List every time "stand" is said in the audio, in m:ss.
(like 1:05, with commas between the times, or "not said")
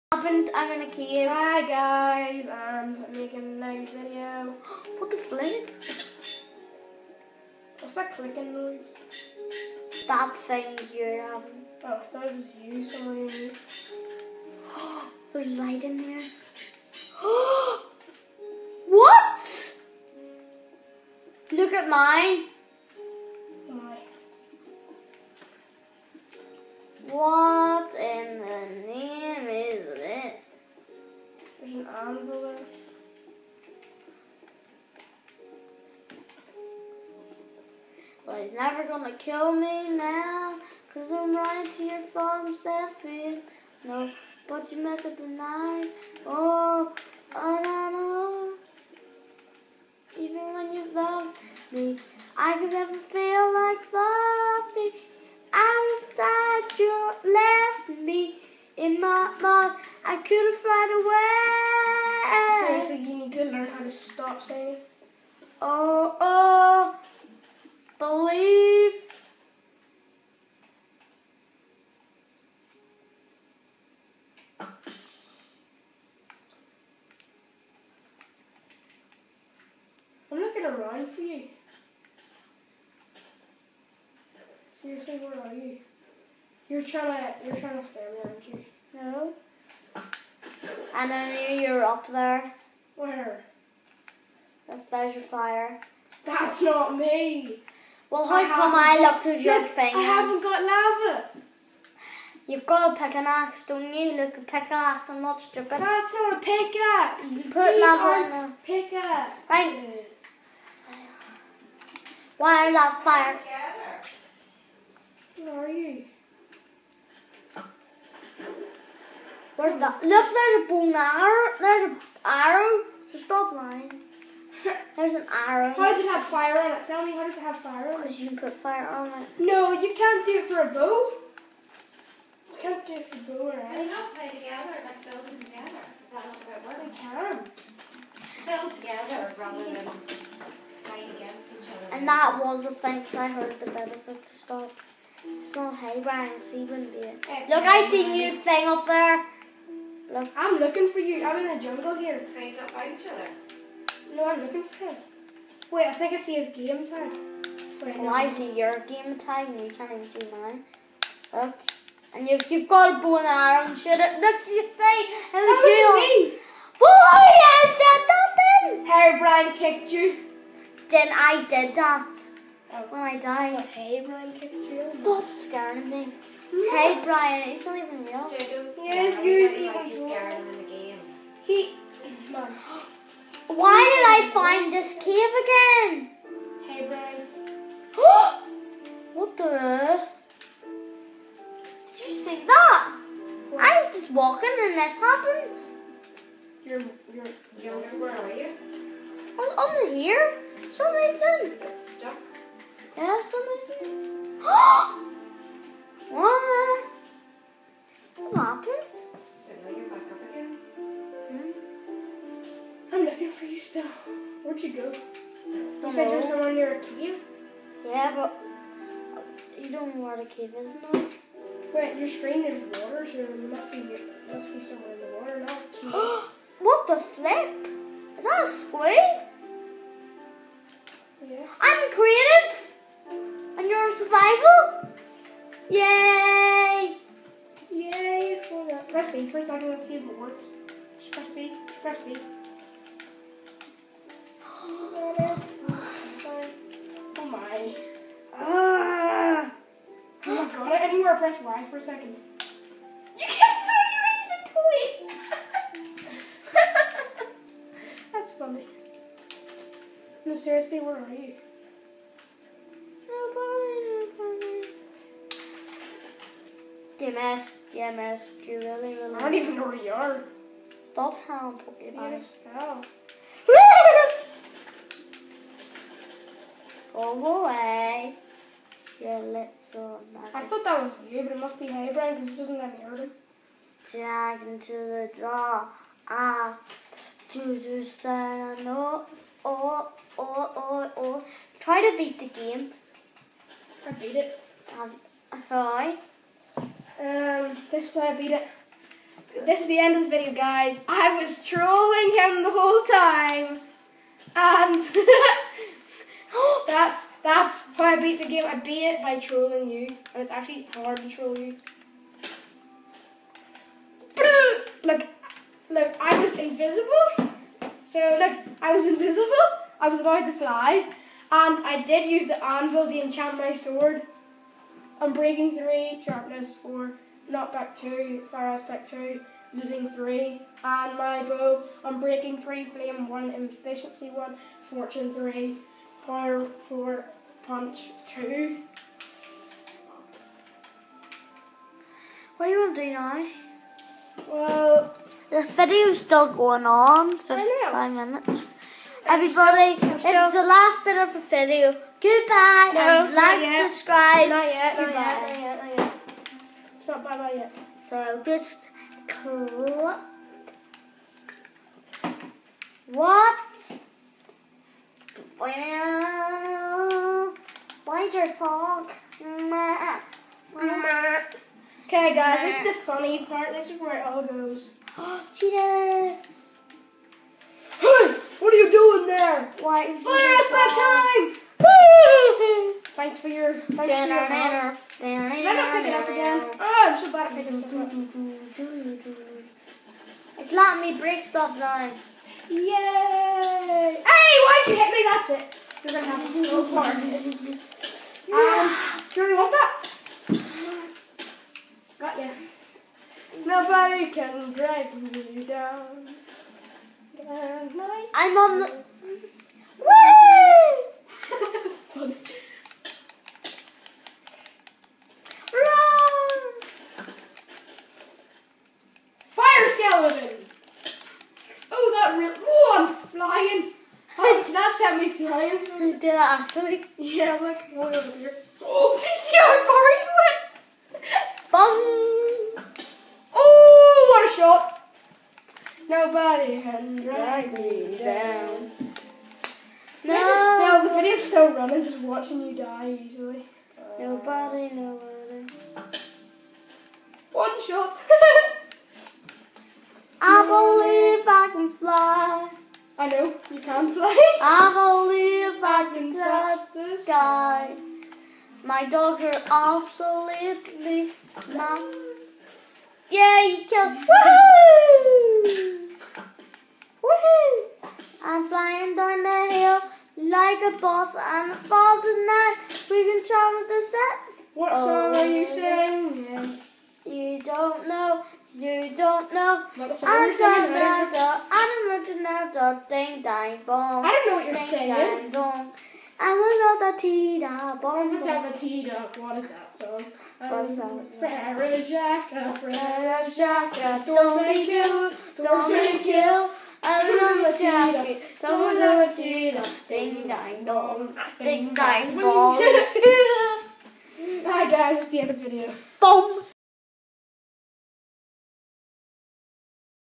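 4:47.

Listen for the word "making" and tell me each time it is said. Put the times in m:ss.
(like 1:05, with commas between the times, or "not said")
0:03.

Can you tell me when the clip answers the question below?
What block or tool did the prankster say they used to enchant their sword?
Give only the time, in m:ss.
5:22.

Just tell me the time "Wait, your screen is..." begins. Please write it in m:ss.
3:41.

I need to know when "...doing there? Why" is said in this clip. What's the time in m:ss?
6:18.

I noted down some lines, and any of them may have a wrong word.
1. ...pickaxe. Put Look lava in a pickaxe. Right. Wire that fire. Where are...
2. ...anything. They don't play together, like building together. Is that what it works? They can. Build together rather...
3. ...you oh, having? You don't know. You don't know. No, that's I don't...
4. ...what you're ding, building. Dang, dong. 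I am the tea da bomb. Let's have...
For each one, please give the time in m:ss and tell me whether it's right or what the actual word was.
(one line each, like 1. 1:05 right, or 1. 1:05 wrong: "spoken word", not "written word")
1. 1:46 wrong: "These", not "Look"
2. 2:13 right
3. 7:55 wrong: "singing", not "having"
4. 8:04 wrong: "saying", not "building".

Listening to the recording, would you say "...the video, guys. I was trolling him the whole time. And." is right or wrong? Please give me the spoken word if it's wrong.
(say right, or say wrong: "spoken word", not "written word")
right.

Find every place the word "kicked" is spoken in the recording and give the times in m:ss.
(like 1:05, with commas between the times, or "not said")
2:49, 2:54.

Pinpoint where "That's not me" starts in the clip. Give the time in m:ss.
1:36.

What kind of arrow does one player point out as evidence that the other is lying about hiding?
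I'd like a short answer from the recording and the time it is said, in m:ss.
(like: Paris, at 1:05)
Bone arrow, at 2:00.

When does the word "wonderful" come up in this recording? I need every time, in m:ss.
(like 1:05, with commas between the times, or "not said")
6:07.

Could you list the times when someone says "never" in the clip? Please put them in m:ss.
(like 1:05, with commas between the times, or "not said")
0:38, 0:52.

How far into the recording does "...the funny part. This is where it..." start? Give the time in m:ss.
6:12.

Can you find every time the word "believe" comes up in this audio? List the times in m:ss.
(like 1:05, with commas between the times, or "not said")
1:07, 7:30.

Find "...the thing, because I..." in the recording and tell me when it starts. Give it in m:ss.
2:22.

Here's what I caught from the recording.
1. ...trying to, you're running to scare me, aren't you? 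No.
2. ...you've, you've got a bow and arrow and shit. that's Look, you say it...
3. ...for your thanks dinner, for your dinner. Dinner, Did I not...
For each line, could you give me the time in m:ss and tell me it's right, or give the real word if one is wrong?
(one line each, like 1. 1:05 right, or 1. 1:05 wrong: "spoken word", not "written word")
1. 1:26 wrong: "trying", not "running"
2. 2:42 right
3. 6:23 right.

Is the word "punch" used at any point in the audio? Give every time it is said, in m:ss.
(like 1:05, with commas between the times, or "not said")
5:37.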